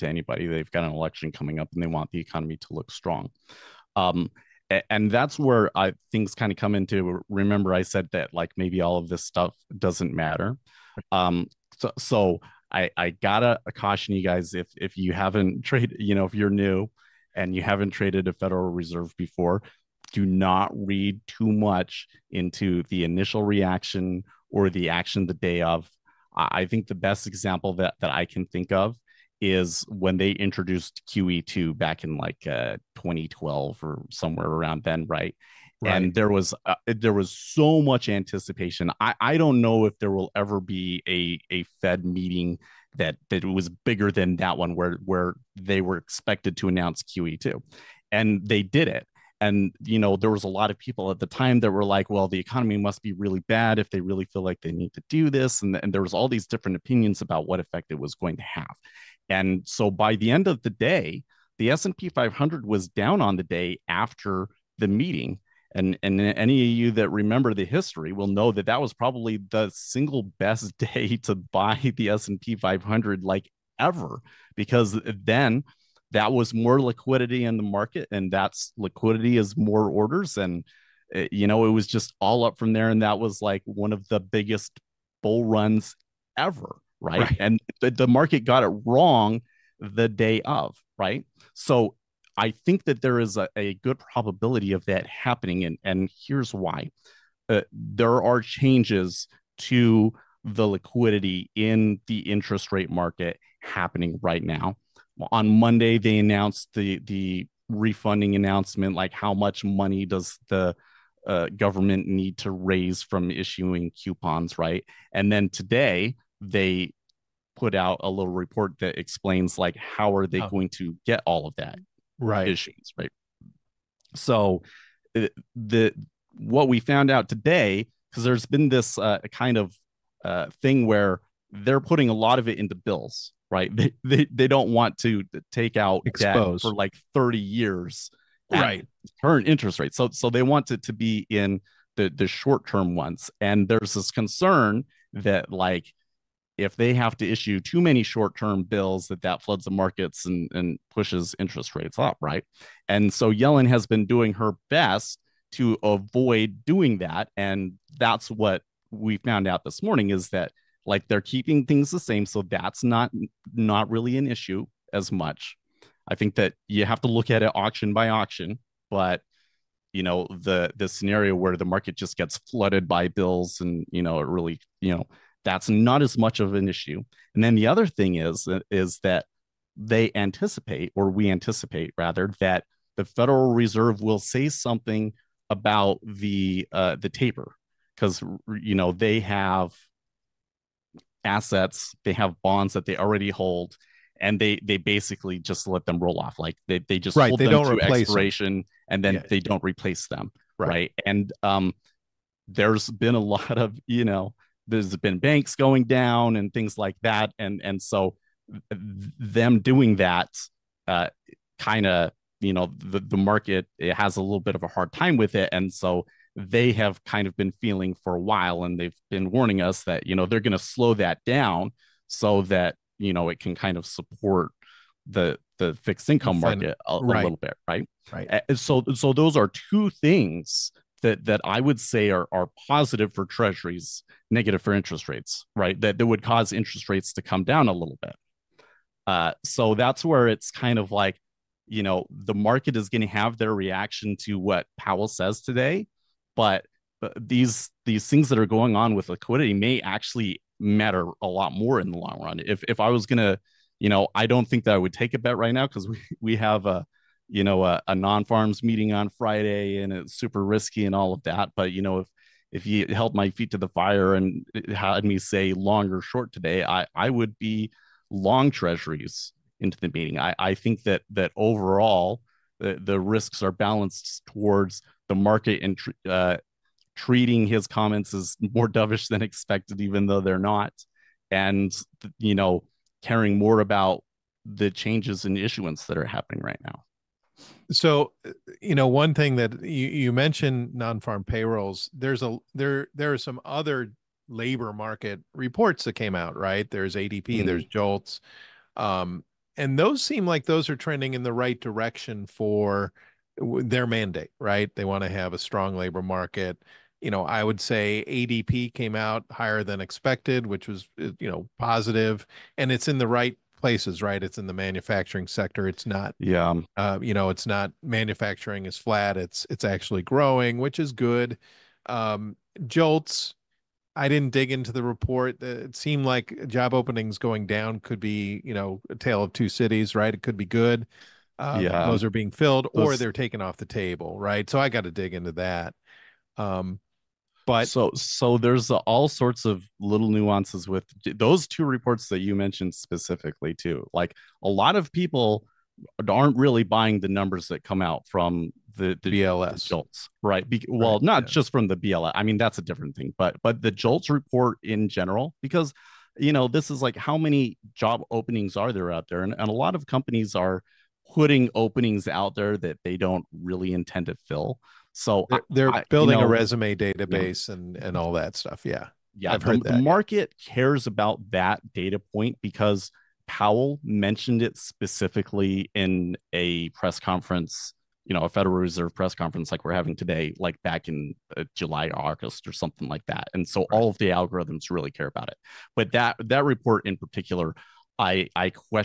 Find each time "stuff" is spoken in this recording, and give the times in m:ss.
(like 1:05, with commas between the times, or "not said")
0:09, 6:08.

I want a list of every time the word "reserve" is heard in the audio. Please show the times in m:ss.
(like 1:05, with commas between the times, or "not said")
0:18, 3:03, 6:18.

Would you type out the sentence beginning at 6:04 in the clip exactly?
So they're, they're I, building you know, a resume database yeah.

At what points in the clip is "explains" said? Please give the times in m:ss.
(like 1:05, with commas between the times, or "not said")
1:58.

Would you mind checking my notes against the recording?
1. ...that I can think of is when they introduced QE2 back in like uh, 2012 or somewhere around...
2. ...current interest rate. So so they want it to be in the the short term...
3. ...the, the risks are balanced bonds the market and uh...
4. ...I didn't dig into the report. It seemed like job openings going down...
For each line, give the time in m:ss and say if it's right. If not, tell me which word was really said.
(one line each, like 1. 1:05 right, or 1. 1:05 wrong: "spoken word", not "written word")
1. 0:28 right
2. 2:19 right
3. 4:32 wrong: "towards", not "bonds"
4. 5:23 right.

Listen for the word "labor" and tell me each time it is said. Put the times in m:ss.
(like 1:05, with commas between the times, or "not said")
4:54, 5:05.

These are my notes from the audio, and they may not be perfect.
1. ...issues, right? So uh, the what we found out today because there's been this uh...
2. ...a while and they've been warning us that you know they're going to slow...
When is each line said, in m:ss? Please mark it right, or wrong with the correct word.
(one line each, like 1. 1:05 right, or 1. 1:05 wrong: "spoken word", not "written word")
1. 2:02 right
2. 3:38 right.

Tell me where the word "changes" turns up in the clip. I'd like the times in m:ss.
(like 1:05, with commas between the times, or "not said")
1:38, 4:44.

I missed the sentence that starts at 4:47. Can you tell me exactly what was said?
So, uh, you know, one thing that you, you mentioned non-farm payrolls.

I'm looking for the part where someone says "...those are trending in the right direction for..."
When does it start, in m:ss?
5:00.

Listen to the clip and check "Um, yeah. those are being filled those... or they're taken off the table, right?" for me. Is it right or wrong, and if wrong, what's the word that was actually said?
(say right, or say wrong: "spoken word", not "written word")
right.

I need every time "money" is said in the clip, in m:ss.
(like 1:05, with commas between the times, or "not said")
1:49.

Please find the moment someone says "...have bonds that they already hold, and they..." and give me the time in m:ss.
3:12.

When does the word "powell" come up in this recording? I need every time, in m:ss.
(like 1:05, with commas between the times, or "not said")
4:04, 6:13.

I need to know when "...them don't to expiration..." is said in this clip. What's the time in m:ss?
3:17.